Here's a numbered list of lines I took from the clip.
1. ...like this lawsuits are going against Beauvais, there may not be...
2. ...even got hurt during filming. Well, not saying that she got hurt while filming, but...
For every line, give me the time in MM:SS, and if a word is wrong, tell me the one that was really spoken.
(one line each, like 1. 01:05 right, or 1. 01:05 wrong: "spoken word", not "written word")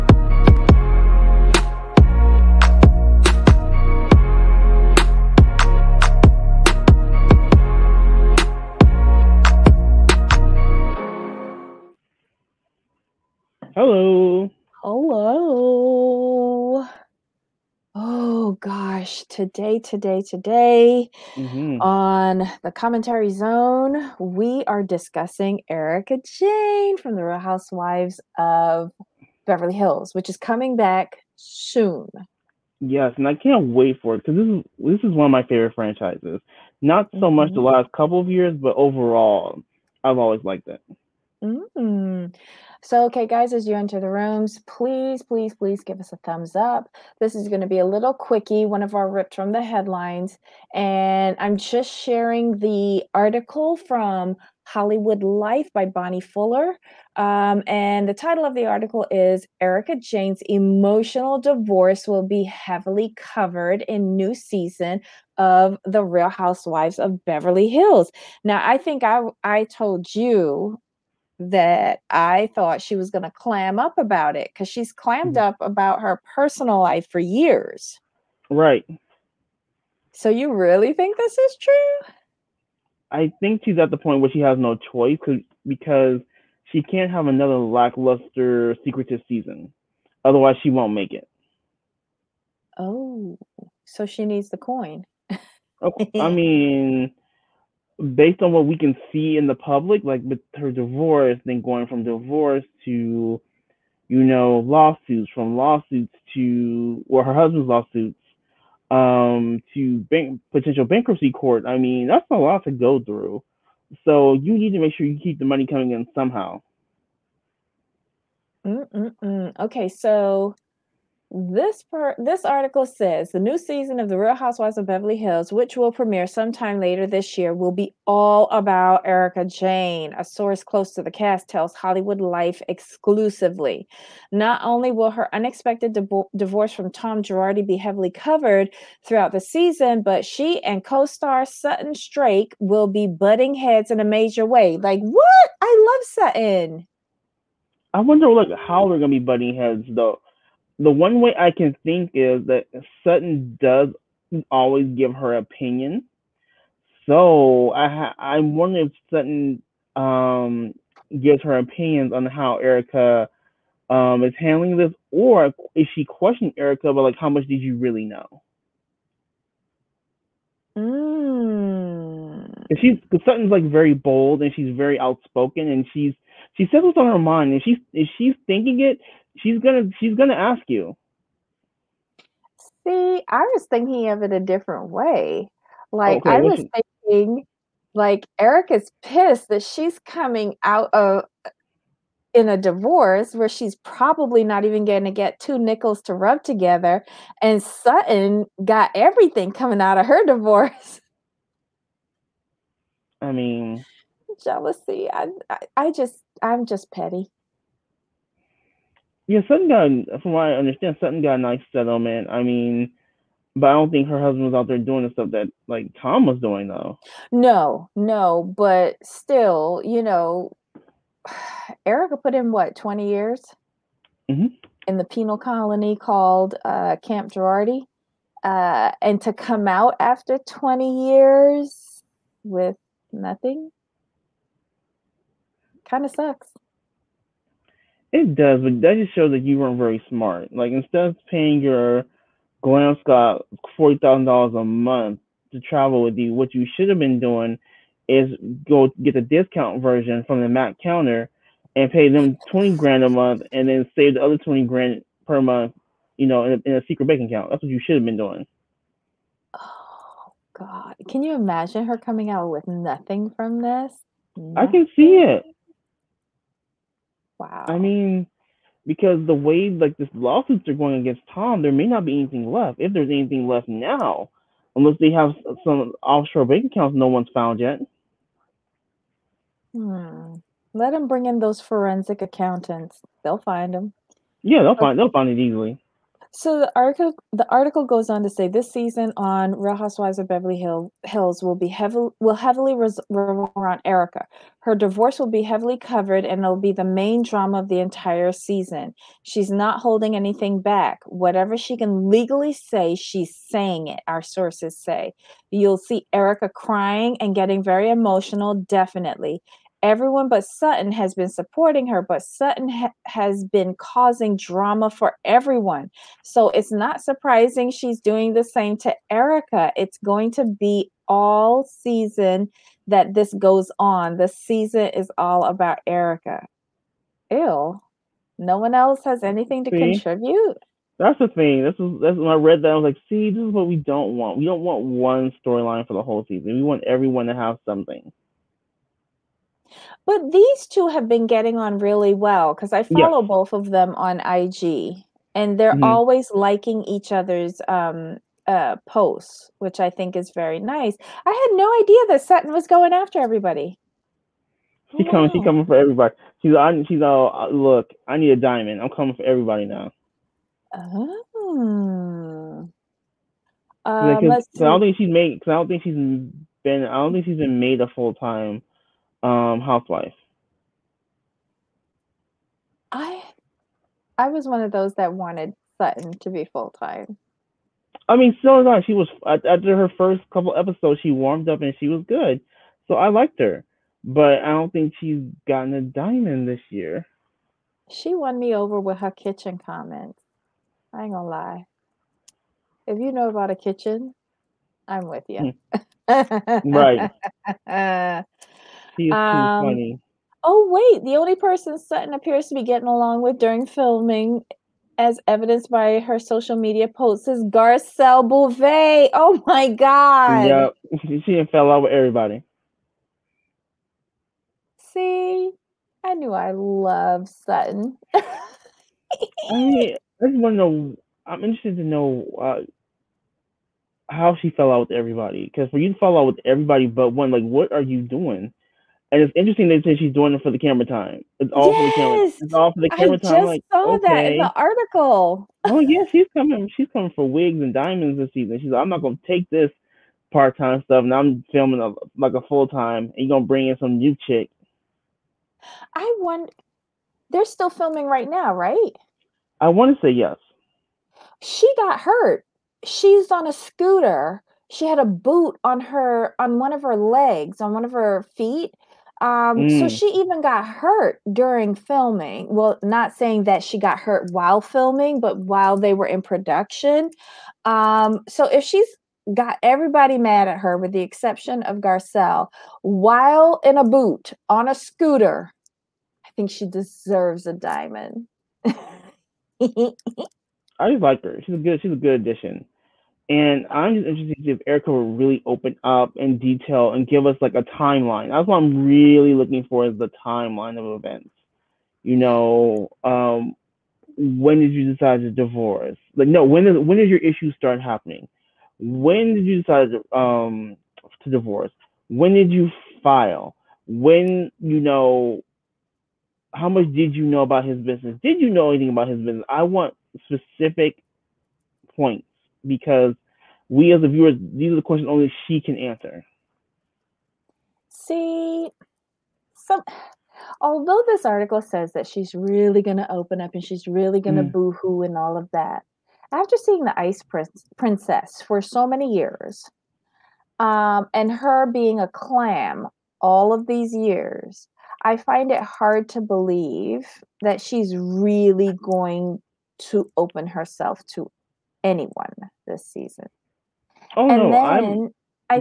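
1. 04:29 wrong: "Tom", not "Beauvais"
2. 07:40 right.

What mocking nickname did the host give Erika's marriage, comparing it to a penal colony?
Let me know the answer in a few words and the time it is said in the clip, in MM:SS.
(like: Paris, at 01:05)
Camp Girardi, at 03:47.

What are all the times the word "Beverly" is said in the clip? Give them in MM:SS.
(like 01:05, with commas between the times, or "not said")
00:29, 01:07, 02:04, 04:50.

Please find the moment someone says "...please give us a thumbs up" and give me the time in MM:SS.
00:45.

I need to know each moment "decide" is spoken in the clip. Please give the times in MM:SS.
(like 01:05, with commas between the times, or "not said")
08:14, 08:19.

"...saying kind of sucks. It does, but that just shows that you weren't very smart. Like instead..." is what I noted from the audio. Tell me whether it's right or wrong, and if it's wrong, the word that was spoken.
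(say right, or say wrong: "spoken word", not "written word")
wrong: "nothing", not "saying".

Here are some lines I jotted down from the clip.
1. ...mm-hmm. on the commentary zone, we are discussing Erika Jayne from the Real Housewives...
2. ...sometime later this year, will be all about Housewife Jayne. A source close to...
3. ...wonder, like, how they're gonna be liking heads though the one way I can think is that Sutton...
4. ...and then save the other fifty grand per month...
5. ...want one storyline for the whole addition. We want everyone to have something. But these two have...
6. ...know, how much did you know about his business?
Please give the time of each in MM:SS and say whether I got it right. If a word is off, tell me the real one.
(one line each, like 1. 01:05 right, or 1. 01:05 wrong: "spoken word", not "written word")
1. 00:21 right
2. 02:06 wrong: "Erika", not "Housewife"
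3. 02:28 wrong: "butting", not "liking"
4. 04:13 wrong: "twenty", not "fifty"
5. 05:34 wrong: "season", not "addition"
6. 08:24 right.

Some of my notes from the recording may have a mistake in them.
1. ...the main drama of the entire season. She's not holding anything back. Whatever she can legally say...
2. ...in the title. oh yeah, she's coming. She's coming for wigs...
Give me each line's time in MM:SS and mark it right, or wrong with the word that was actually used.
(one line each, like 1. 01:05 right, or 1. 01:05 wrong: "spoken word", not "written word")
1. 04:56 right
2. 07:14 wrong: "article", not "title".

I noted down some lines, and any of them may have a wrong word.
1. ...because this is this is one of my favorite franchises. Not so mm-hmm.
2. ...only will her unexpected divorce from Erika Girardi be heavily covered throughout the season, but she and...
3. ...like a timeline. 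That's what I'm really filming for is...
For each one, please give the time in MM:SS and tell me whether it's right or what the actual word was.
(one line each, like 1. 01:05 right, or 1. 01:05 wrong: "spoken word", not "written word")
1. 00:34 right
2. 02:14 wrong: "Tom", not "Erika"
3. 08:07 wrong: "looking", not "filming".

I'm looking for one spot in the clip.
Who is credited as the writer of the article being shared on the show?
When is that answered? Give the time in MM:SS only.
00:55.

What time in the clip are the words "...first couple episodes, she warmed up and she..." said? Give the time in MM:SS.
06:19.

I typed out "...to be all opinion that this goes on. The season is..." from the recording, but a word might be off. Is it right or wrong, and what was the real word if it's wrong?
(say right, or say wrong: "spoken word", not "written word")
wrong: "season", not "opinion".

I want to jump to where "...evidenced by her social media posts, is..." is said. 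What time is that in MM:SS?
06:45.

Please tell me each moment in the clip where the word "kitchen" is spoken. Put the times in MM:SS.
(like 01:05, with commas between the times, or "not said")
06:29, 06:33.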